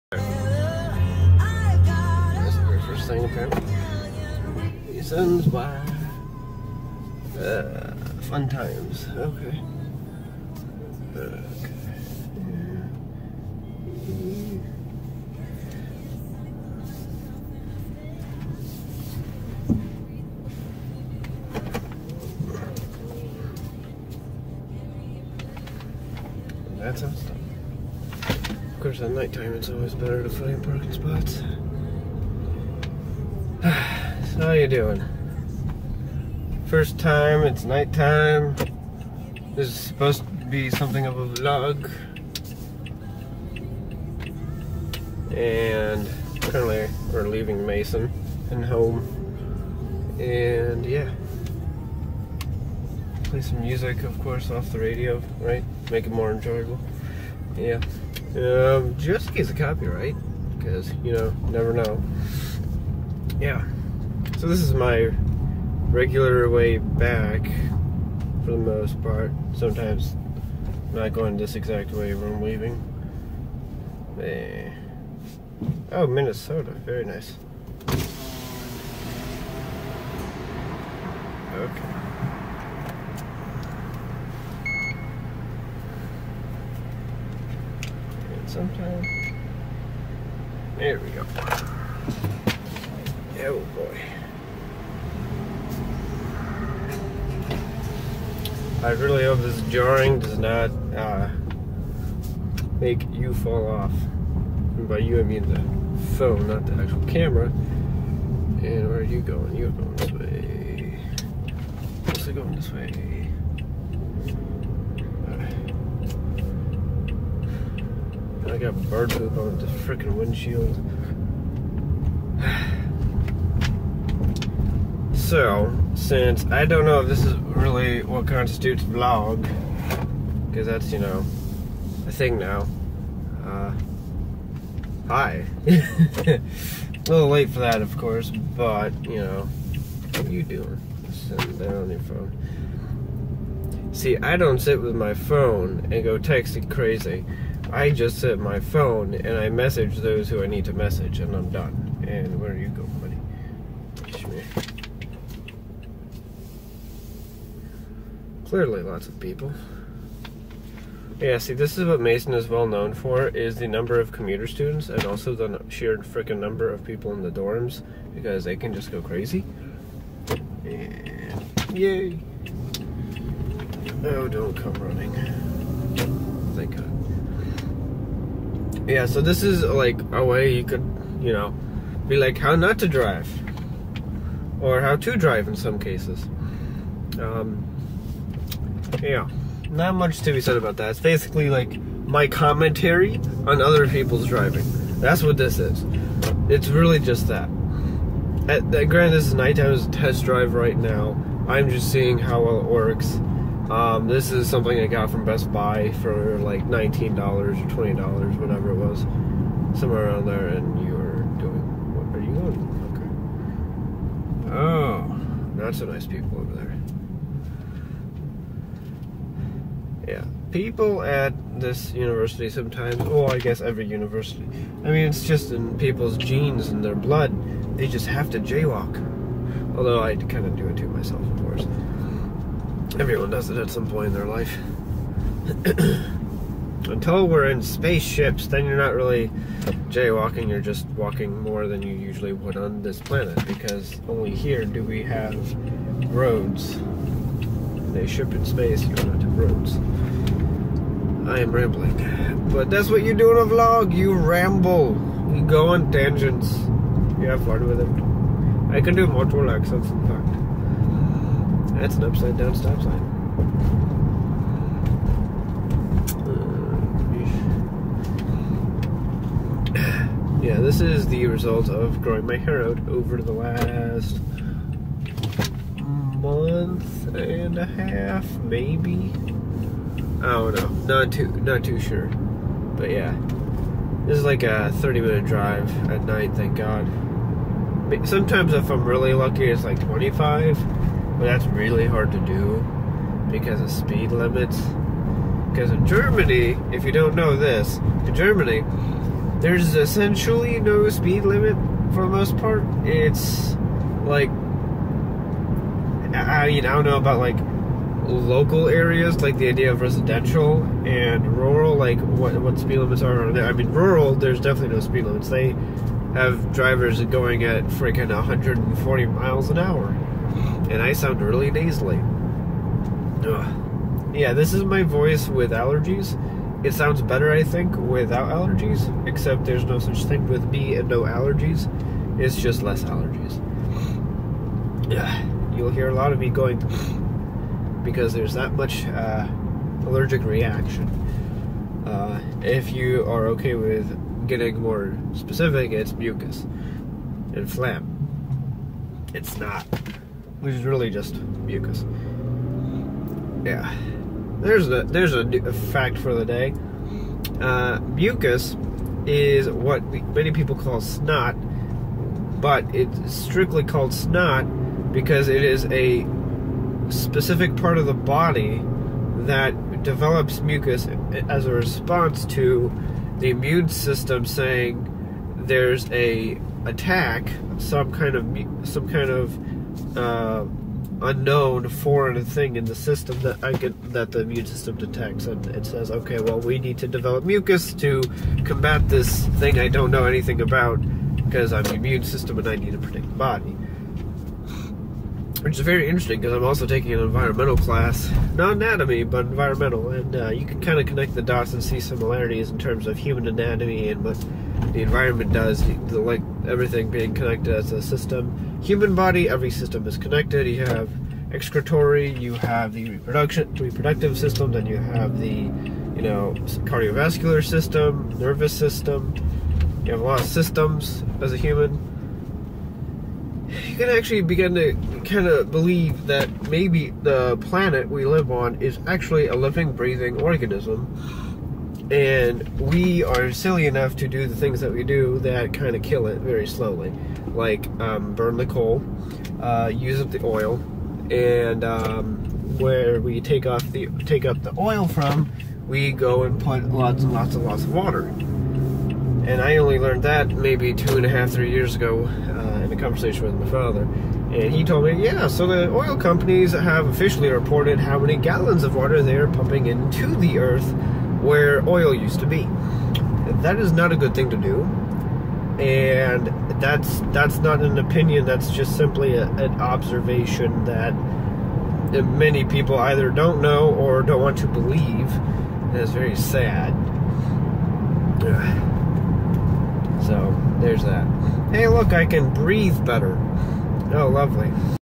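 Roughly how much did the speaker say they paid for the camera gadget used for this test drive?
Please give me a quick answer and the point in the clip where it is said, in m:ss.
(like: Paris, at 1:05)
$19, at 3:26.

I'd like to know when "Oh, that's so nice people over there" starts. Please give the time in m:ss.
3:34.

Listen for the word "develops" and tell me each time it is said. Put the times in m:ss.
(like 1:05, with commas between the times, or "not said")
6:09, 6:26.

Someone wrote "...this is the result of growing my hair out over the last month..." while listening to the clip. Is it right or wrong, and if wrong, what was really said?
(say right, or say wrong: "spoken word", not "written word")
right.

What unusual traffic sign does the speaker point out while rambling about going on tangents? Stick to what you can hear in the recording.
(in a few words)
upside down stop sign.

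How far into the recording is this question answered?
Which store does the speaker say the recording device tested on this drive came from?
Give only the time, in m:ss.
3:25.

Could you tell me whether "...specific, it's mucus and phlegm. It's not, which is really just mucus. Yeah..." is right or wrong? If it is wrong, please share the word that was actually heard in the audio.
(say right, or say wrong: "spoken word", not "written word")
right.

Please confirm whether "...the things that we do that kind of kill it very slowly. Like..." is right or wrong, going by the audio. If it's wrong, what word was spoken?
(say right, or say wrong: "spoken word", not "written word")
right.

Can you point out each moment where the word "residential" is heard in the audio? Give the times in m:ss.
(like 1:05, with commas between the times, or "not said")
5:09.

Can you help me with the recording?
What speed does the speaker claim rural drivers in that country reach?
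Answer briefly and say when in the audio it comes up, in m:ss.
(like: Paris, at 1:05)
140 miles an hour, at 5:18.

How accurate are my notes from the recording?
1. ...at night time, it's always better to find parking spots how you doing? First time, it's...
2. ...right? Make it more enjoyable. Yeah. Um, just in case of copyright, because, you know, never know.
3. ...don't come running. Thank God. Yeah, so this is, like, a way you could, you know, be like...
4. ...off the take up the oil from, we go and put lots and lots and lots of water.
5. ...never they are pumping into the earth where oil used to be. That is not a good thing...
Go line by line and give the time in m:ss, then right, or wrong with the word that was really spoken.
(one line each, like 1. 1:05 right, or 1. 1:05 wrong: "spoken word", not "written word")
1. 0:29 right
2. 0:55 right
3. 2:54 right
4. 7:23 right
5. 7:38 wrong: "water", not "never".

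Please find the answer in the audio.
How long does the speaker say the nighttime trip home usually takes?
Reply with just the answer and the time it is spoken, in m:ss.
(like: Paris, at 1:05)
30 minutes, at 4:44.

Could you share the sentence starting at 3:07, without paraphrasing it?
Um, yeah, not much to be said about that.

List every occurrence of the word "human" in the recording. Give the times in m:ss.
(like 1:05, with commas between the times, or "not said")
6:42, 6:48, 7:01.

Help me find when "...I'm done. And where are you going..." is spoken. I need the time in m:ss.
2:31.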